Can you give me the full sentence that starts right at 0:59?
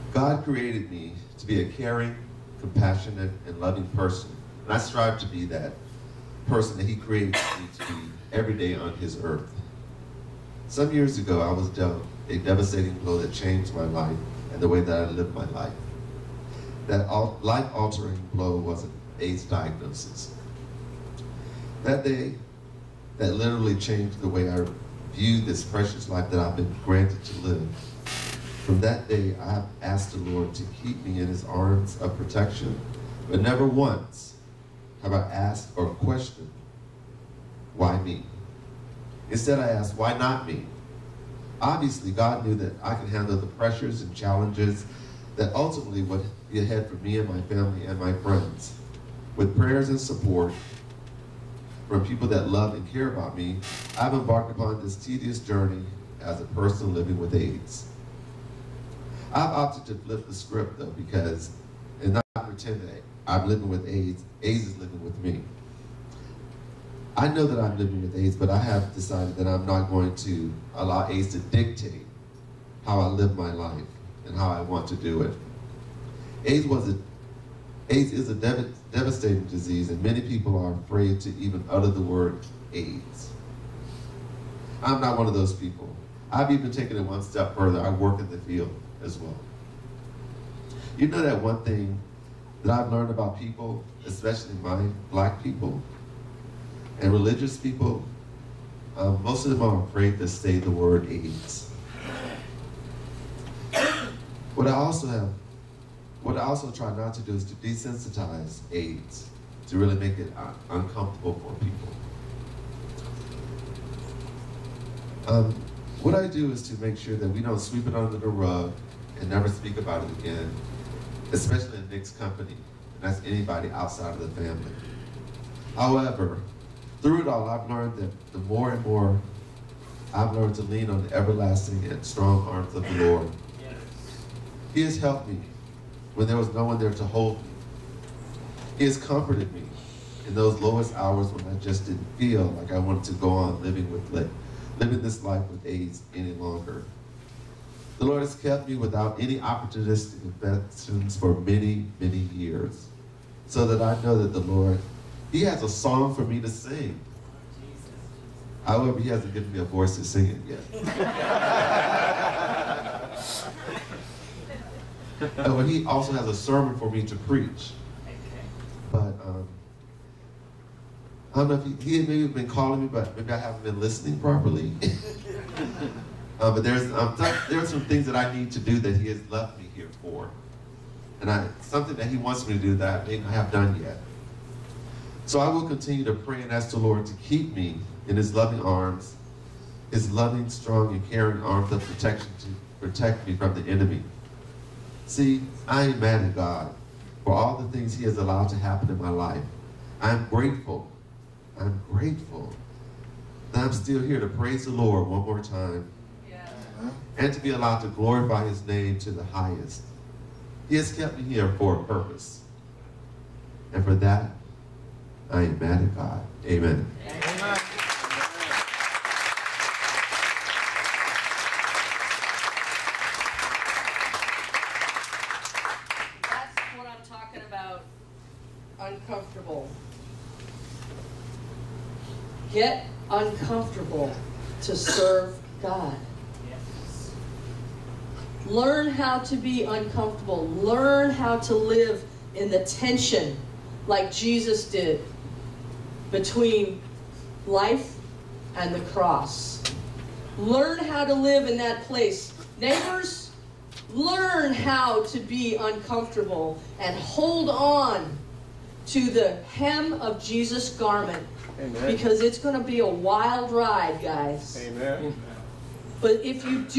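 I've opted to flip the script though because, and not pretend that I'm living with AIDS, AIDS is living with me.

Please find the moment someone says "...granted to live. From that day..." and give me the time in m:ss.
0:26.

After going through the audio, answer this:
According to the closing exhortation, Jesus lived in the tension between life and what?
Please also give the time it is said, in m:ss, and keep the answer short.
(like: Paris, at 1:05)
the cross, at 4:08.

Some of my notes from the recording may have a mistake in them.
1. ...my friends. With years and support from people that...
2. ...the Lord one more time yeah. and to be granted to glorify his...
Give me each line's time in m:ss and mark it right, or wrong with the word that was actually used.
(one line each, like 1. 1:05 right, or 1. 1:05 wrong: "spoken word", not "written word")
1. 0:47 wrong: "prayers", not "years"
2. 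3:24 wrong: "allowed", not "granted".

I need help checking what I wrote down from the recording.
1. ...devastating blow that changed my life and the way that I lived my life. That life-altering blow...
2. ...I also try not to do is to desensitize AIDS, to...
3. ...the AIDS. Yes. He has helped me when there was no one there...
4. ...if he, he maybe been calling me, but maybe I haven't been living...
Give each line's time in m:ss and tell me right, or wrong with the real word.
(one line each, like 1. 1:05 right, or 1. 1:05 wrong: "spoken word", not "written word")
1. 0:12 right
2. 1:46 right
3. 2:12 wrong: "Lord", not "AIDS"
4. 2:51 wrong: "listening", not "living".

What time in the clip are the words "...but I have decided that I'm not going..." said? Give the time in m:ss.
1:08.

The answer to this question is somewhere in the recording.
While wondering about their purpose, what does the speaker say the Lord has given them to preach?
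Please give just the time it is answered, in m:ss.
2:46.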